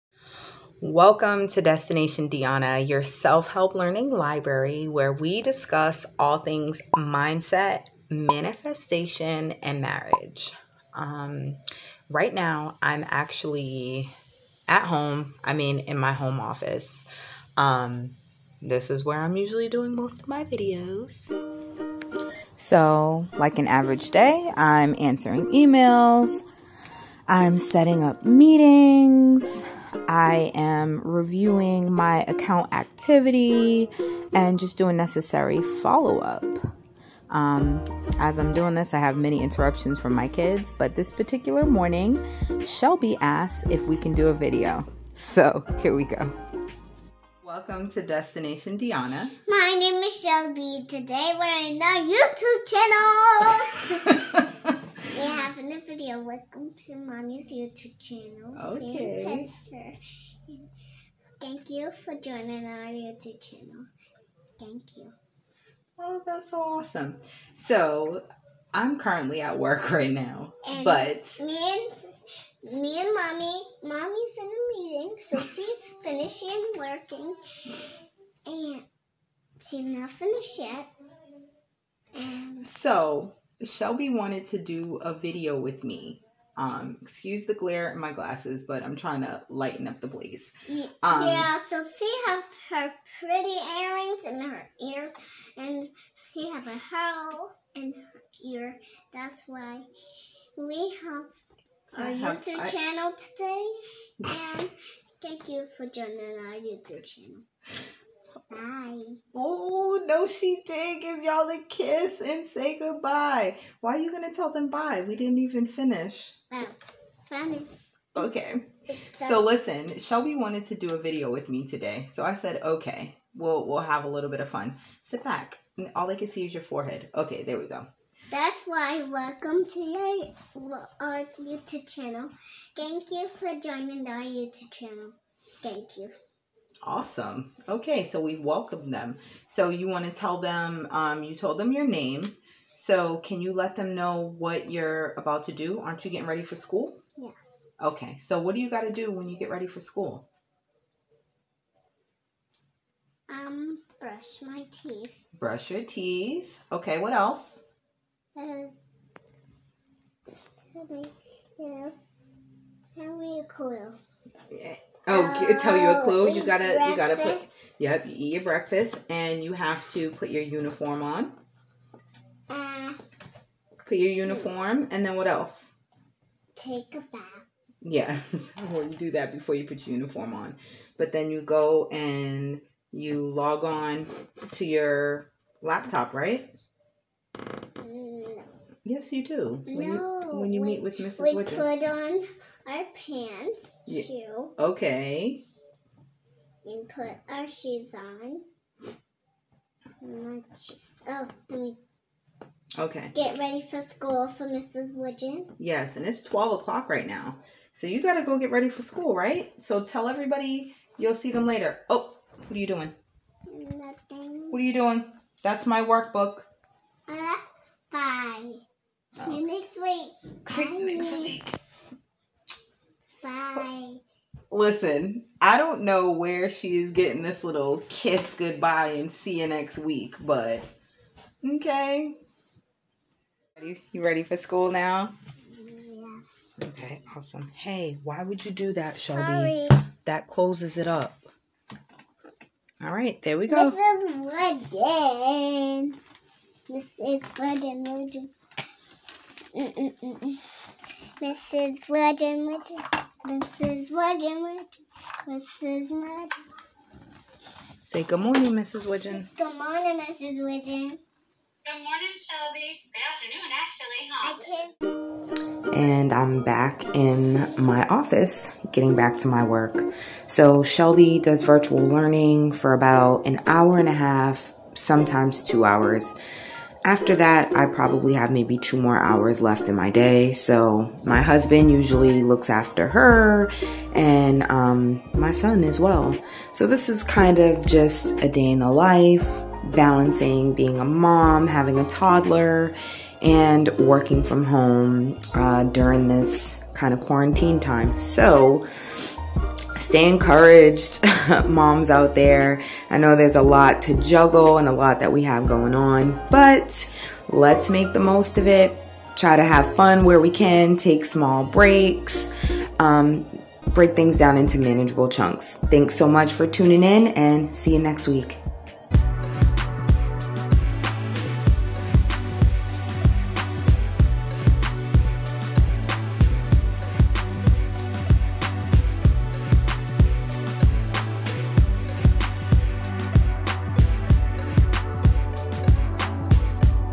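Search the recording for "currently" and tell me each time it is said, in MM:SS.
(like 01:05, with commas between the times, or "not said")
01:08.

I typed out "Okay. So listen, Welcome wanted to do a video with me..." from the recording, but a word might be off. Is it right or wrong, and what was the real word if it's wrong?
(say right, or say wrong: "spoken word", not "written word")
wrong: "Shellbe", not "Welcome".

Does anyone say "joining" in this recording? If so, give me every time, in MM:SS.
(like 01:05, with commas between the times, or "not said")
01:02, 01:45, 02:13.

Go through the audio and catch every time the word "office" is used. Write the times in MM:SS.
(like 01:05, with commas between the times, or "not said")
00:16, 04:27.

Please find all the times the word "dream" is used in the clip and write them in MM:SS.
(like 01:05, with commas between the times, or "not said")
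not said.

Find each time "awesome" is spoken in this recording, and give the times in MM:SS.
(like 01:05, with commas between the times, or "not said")
01:06, 02:16, 03:57.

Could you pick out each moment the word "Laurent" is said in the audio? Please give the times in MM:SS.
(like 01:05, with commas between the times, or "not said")
not said.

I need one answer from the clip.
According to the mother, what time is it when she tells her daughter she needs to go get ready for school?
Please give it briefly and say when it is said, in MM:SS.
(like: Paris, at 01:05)
12 o'clock, at 03:26.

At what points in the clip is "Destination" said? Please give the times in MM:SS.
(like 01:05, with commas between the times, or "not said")
00:01, 00:48.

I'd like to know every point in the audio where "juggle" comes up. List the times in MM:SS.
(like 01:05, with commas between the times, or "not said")
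05:03.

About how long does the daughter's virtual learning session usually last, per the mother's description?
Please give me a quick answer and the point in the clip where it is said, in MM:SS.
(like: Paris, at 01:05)
an hour and a half, at 04:33.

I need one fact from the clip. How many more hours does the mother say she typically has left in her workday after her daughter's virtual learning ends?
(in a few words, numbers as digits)
2.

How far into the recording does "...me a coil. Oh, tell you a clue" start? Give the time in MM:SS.
02:43.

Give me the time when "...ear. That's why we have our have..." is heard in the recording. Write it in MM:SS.
01:38.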